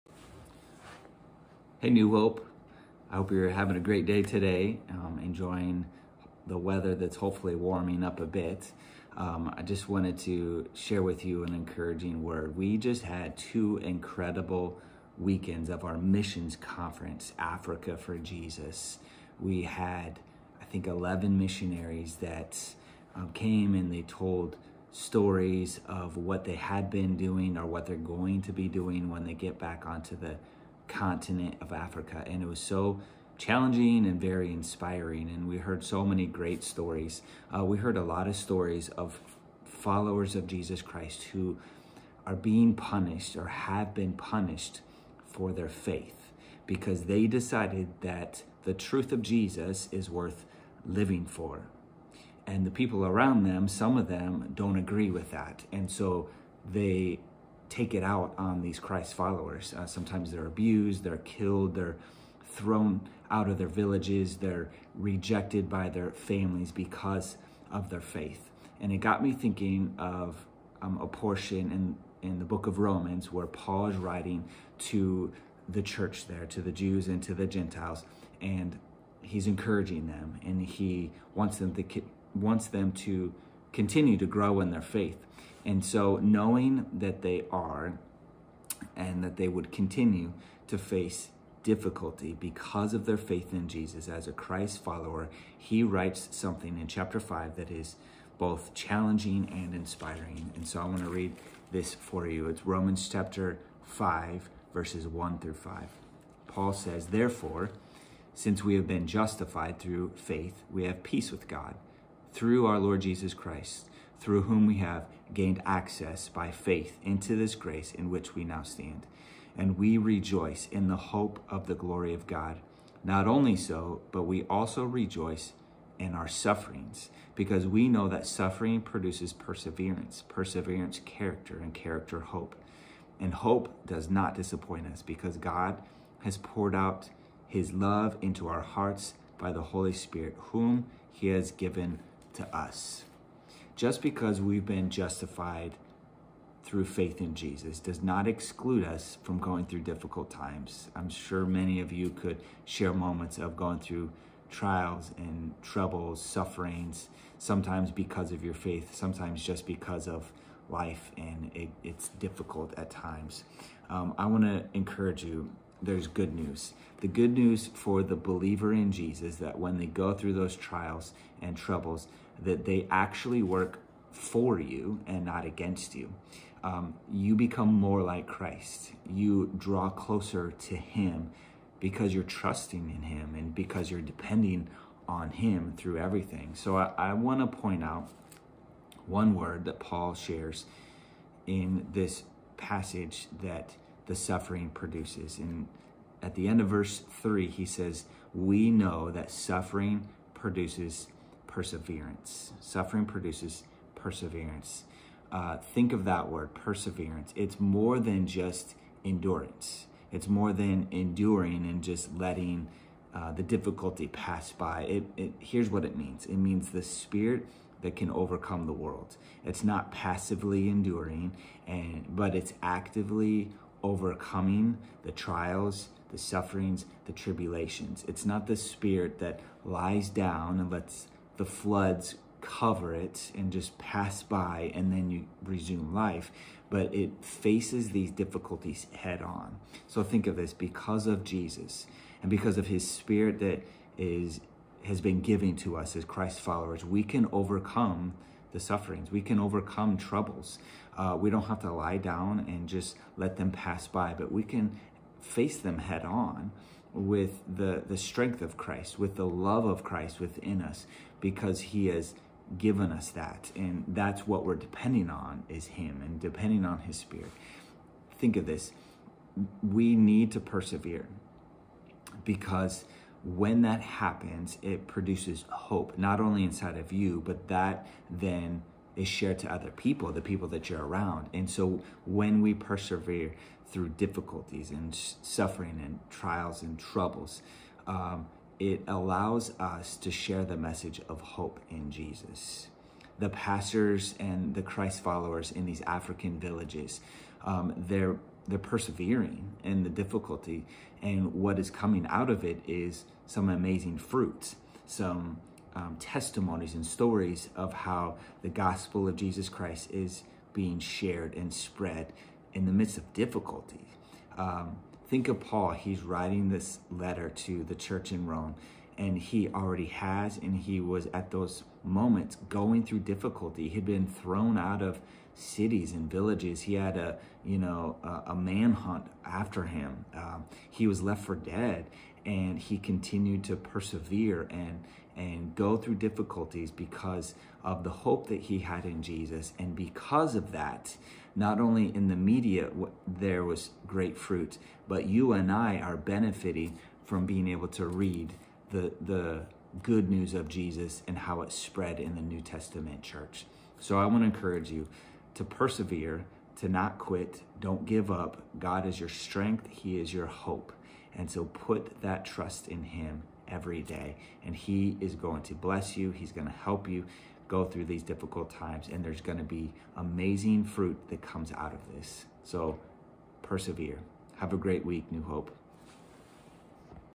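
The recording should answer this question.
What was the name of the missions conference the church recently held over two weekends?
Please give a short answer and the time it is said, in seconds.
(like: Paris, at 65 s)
Africa for Jesus, at 17 s.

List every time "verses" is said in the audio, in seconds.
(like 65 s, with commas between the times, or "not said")
104 s, 196 s.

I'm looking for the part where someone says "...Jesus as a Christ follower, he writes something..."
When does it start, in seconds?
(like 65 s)
93 s.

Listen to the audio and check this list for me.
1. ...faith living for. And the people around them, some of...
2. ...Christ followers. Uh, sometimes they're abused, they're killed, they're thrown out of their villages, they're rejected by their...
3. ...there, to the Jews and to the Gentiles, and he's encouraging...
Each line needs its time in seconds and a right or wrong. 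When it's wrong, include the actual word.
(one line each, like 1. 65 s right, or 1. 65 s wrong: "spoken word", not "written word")
1. 50 s wrong: "worth", not "faith"
2. 58 s right
3. 76 s right.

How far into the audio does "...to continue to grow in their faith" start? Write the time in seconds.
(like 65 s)
82 s.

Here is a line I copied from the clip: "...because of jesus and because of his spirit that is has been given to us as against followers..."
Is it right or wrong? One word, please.
wrong.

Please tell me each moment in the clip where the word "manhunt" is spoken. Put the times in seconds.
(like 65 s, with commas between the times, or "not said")
328 s.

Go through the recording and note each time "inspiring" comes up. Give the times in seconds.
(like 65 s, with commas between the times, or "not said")
34 s, 99 s.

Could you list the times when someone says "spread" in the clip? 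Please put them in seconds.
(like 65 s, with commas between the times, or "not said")
311 s, 351 s.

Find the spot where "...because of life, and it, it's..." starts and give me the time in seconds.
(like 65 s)
159 s.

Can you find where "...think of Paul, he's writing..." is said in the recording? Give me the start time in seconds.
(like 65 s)
315 s.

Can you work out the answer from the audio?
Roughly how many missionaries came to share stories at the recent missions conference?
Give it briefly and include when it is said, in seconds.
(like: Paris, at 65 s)
11, at 20 s.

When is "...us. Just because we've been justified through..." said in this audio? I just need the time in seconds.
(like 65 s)
142 s.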